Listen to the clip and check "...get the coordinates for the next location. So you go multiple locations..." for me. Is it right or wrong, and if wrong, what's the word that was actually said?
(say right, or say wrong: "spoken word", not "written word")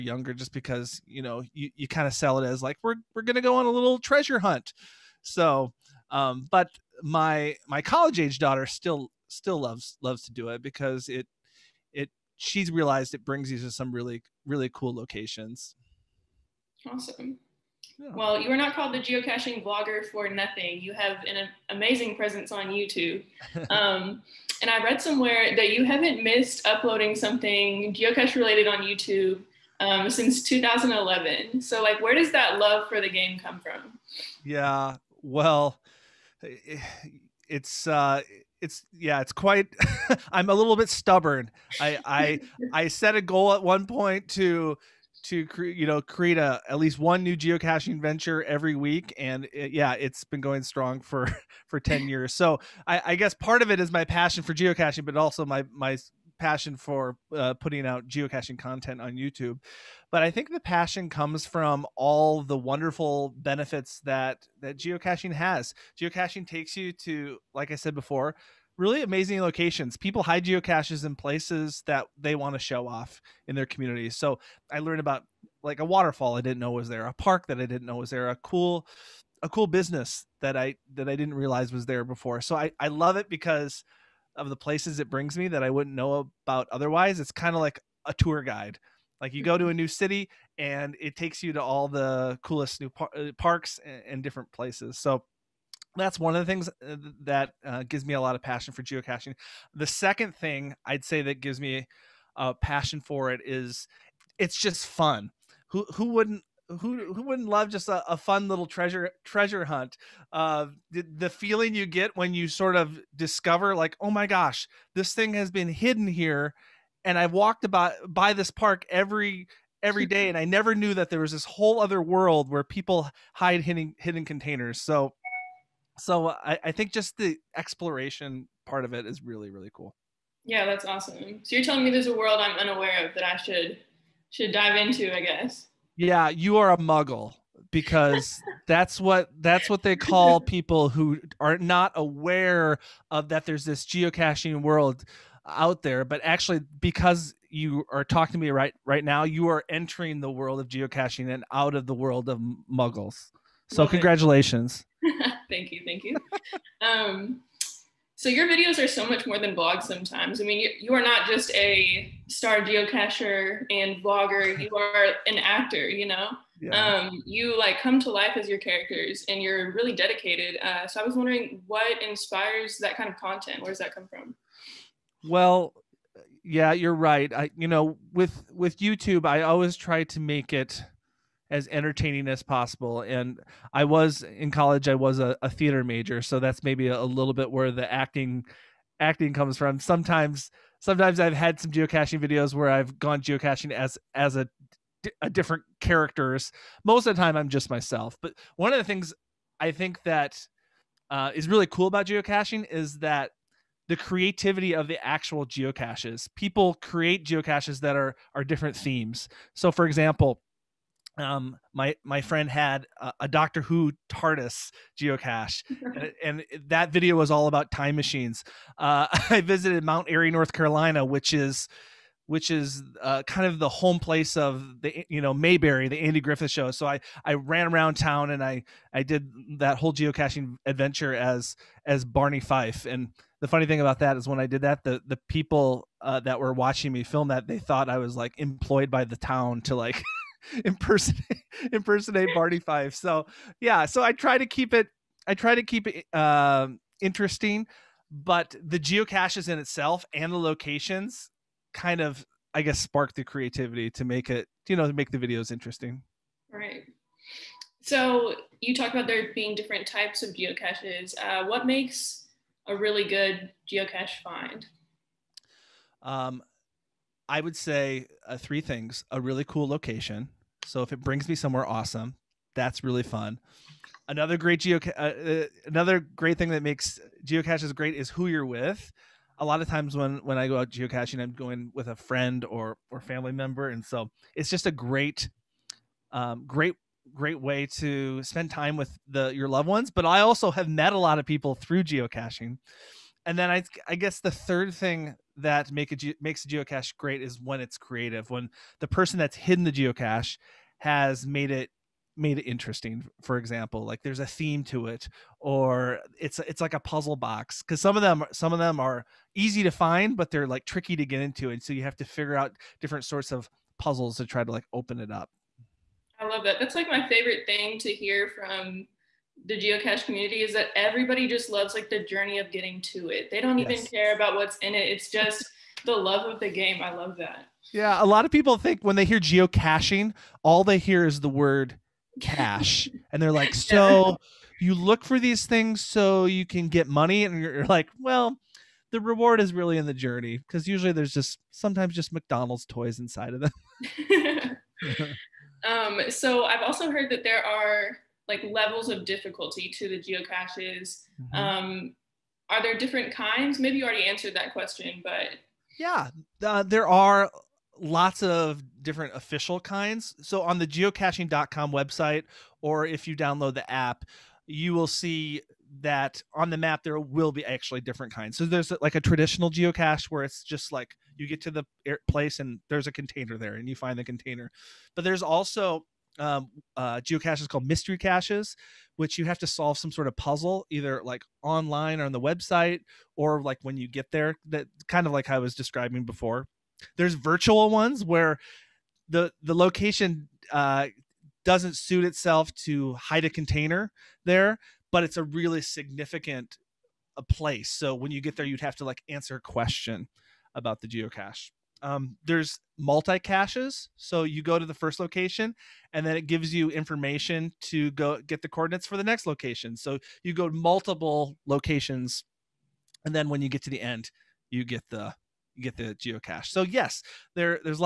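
right.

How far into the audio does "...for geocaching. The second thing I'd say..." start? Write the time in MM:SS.
01:38.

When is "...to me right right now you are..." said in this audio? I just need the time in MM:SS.
02:28.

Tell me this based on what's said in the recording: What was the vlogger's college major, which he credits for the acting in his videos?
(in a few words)
theater.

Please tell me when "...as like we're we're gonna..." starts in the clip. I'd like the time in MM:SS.
00:02.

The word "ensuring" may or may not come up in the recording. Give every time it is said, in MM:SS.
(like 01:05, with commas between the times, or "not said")
not said.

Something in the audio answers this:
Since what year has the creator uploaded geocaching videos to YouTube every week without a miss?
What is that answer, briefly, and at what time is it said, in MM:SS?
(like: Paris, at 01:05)
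2011, at 00:30.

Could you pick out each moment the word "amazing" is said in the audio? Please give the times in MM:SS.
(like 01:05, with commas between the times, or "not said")
00:21, 01:09.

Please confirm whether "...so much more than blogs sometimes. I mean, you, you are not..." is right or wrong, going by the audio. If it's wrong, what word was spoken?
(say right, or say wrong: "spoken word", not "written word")
right.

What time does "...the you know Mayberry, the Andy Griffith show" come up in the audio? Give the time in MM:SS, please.
03:44.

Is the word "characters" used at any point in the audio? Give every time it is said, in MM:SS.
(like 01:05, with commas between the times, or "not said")
02:48, 03:15.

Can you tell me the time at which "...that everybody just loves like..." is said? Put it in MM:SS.
05:20.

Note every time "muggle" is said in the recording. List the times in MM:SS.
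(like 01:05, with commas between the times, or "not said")
02:16, 02:32.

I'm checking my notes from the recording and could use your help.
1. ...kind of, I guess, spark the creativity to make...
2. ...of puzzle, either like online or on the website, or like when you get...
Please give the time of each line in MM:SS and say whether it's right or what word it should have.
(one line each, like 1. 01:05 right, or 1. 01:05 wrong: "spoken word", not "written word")
1. 04:11 right
2. 06:20 right.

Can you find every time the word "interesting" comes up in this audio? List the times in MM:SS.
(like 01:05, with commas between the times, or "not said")
04:07, 04:15, 05:02.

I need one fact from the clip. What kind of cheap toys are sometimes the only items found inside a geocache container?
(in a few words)
McDonald's toys.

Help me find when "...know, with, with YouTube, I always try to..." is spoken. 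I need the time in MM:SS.
02:57.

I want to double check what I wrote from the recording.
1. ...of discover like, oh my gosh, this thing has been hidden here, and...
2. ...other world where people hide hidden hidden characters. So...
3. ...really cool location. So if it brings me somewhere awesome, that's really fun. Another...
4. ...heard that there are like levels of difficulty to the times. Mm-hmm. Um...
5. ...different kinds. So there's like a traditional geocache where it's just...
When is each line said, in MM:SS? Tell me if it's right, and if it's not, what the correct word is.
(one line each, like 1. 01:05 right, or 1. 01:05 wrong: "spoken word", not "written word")
1. 01:52 right
2. 02:01 wrong: "containers", not "characters"
3. 04:29 right
4. 05:46 wrong: "geocaches", not "times"
5. 06:07 right.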